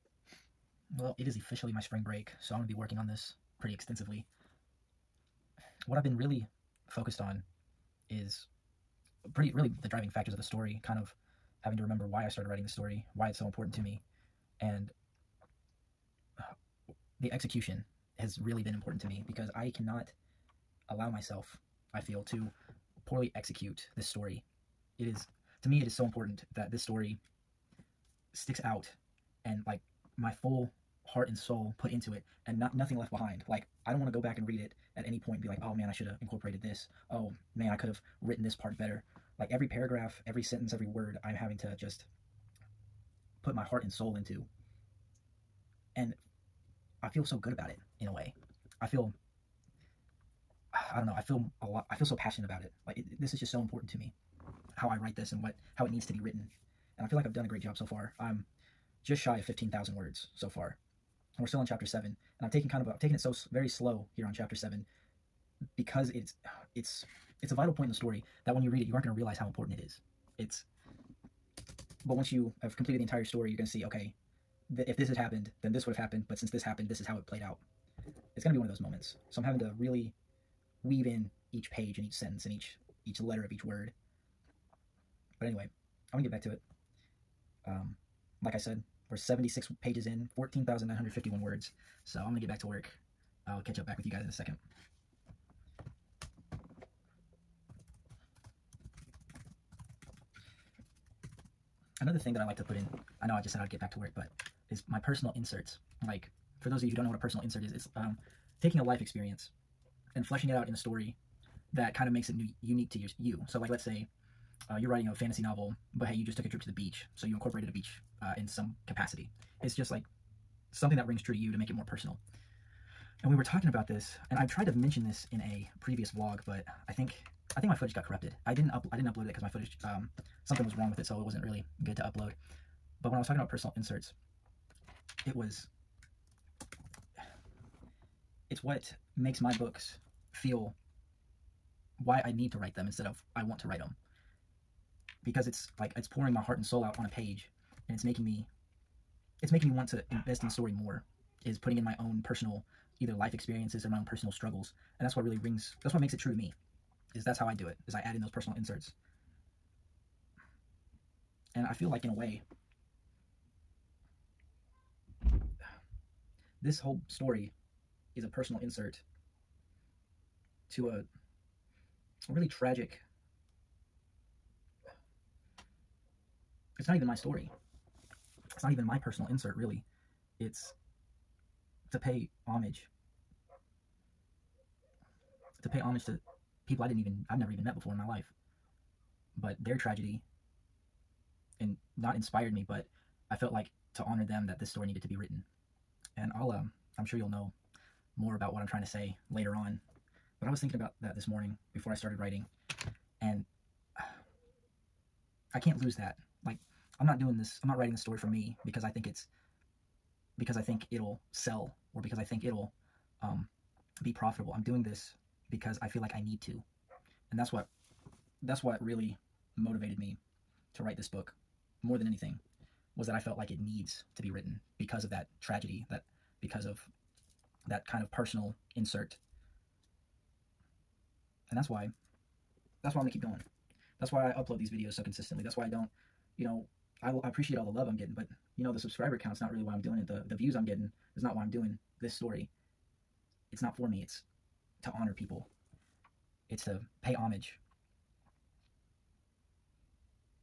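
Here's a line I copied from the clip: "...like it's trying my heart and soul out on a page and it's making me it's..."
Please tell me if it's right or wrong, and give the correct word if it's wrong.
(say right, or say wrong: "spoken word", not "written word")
wrong: "pouring", not "trying".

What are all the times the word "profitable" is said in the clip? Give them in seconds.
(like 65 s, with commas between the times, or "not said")
214 s.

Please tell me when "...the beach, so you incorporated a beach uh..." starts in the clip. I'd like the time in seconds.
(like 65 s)
116 s.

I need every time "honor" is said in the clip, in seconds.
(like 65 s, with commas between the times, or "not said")
194 s, 244 s.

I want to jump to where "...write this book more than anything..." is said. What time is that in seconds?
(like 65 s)
220 s.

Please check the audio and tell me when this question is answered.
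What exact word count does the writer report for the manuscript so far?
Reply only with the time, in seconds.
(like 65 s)
90 s.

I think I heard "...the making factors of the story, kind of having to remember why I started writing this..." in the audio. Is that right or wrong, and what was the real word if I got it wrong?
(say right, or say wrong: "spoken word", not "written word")
wrong: "driving", not "making".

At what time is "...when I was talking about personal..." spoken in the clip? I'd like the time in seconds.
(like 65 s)
133 s.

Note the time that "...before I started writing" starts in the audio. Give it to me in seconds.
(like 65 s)
201 s.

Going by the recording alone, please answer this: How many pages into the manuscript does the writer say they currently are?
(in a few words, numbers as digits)
76.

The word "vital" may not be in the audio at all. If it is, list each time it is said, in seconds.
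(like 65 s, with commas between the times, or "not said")
67 s.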